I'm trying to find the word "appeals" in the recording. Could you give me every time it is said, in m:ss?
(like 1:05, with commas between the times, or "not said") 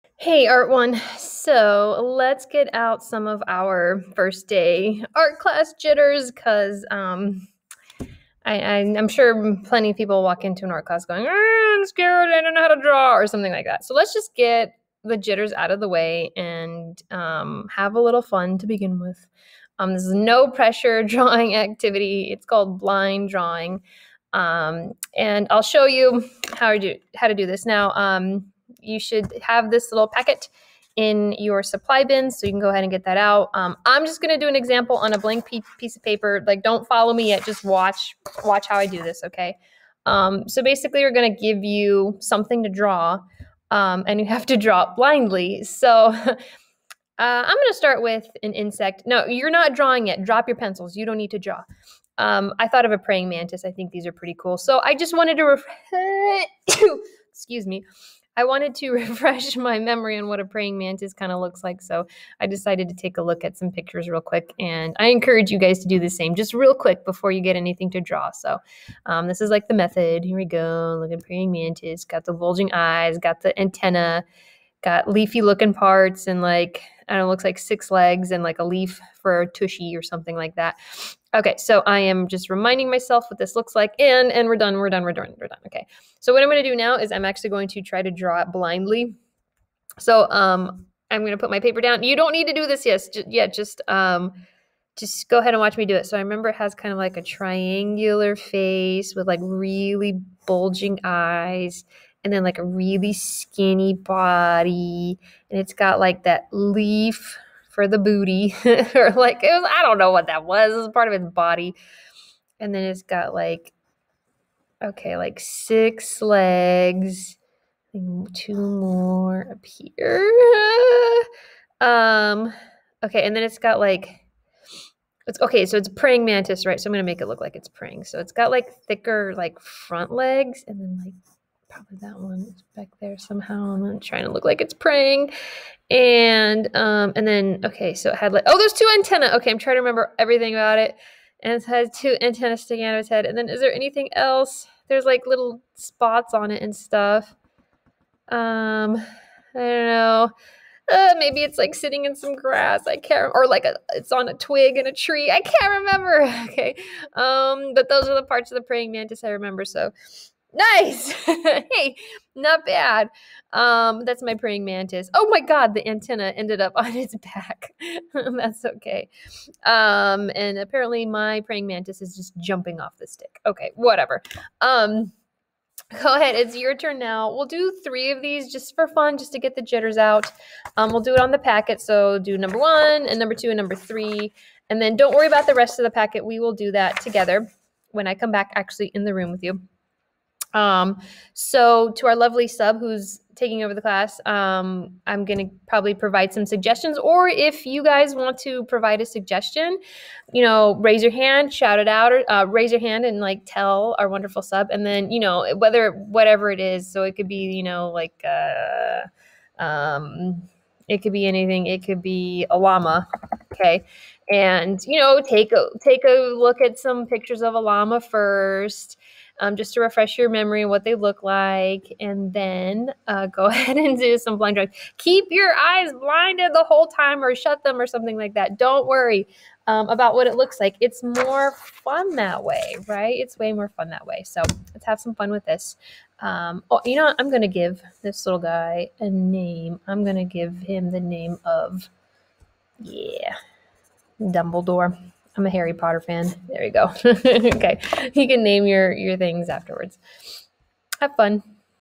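not said.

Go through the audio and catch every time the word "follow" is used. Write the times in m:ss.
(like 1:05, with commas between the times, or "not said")
0:36.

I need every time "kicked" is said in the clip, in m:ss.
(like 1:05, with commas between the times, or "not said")
not said.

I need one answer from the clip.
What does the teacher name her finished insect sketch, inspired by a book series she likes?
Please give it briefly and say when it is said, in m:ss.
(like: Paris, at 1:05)
Dumbledore, at 4:04.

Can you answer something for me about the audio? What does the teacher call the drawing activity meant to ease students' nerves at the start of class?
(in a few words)
Blind drawing.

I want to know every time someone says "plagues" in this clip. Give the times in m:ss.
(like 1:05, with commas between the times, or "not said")
not said.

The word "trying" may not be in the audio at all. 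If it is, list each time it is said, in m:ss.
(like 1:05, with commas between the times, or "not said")
2:13, 2:19.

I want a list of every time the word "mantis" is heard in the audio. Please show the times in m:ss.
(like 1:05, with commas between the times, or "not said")
0:53, 1:00, 1:11, 2:06, 2:38, 2:44, 2:51.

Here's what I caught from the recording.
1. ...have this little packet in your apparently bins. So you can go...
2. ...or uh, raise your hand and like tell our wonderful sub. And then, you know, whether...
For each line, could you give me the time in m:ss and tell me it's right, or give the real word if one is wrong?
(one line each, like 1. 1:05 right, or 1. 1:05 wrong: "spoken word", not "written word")
1. 0:29 wrong: "supply", not "apparently"
2. 3:22 right.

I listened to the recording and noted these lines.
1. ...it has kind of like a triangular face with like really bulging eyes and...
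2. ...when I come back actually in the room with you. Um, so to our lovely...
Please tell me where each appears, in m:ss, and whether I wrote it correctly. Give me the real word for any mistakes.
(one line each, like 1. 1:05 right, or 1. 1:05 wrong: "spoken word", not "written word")
1. 1:36 right
2. 3:07 right.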